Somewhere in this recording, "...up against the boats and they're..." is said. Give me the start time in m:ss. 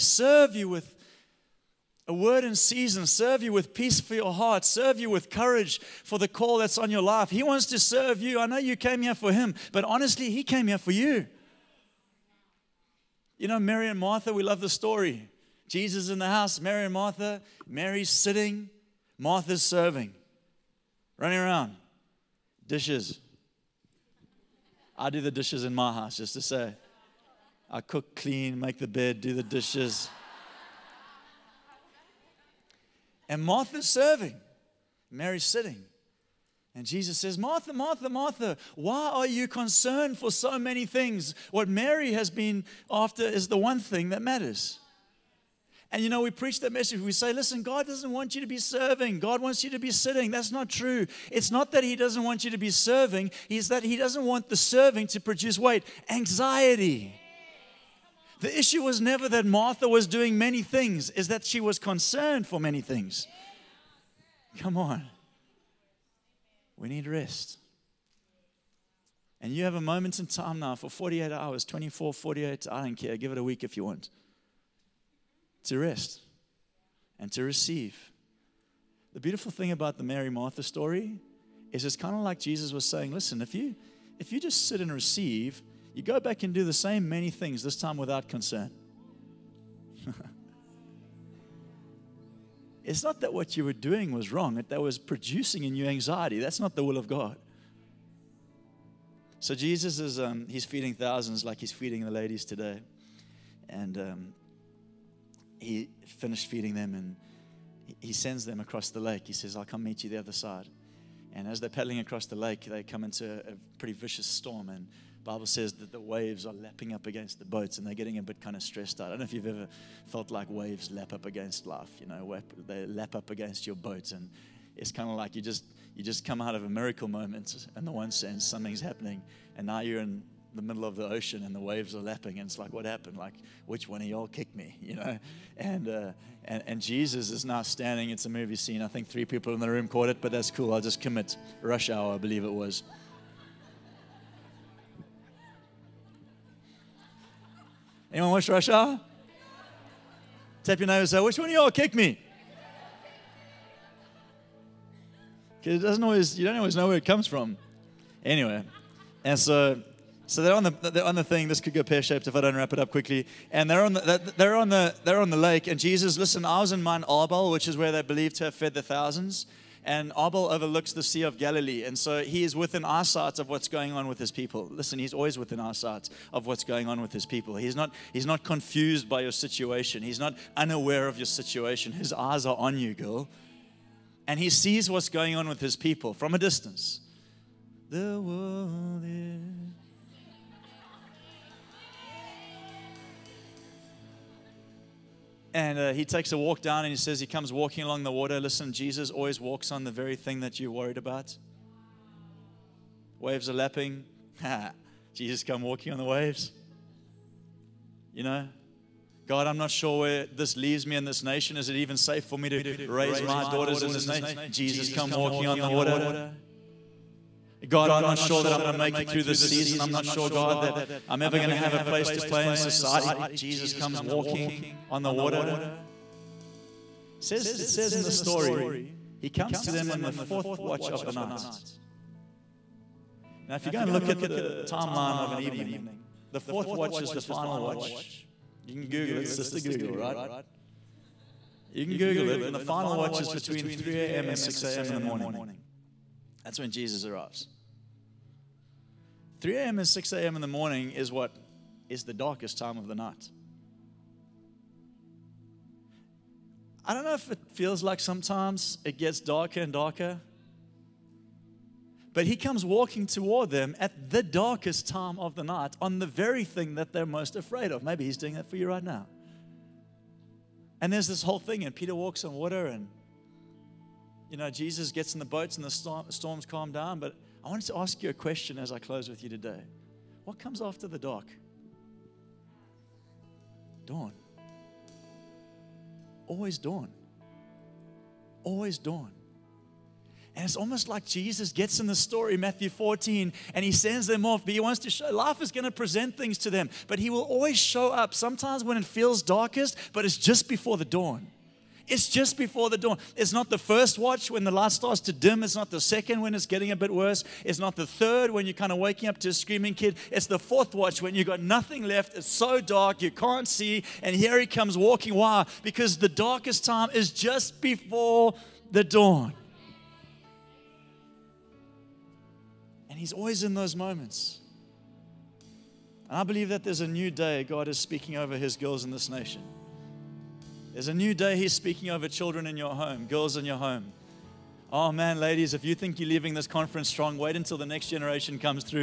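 1:56.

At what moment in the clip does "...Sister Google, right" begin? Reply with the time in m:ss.
3:59.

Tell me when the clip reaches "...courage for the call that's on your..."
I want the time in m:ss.
0:05.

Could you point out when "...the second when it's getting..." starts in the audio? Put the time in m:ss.
5:05.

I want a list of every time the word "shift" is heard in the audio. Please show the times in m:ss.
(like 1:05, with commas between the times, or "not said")
not said.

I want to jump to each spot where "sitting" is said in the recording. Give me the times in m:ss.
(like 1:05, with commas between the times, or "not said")
0:18, 0:35, 0:49.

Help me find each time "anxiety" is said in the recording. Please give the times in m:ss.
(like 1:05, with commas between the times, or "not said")
0:56, 1:35.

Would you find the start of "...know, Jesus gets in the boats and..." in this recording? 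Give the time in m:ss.
4:34.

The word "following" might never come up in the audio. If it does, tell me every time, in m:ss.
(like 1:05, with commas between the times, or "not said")
not said.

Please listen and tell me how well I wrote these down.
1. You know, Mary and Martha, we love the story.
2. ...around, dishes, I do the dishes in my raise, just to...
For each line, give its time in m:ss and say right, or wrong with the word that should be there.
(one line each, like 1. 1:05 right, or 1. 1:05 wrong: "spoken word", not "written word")
1. 0:13 right
2. 0:21 wrong: "house", not "raise".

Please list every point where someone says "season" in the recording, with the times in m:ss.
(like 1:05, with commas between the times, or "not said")
0:02, 3:39.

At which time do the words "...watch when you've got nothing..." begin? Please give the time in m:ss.
5:10.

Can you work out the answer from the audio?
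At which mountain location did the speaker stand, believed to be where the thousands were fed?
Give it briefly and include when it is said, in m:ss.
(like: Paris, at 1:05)
Mount Arbel, at 2:46.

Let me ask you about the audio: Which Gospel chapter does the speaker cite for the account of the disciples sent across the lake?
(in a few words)
Matthew 14.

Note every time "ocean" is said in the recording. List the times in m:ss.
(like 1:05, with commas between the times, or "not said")
2:11.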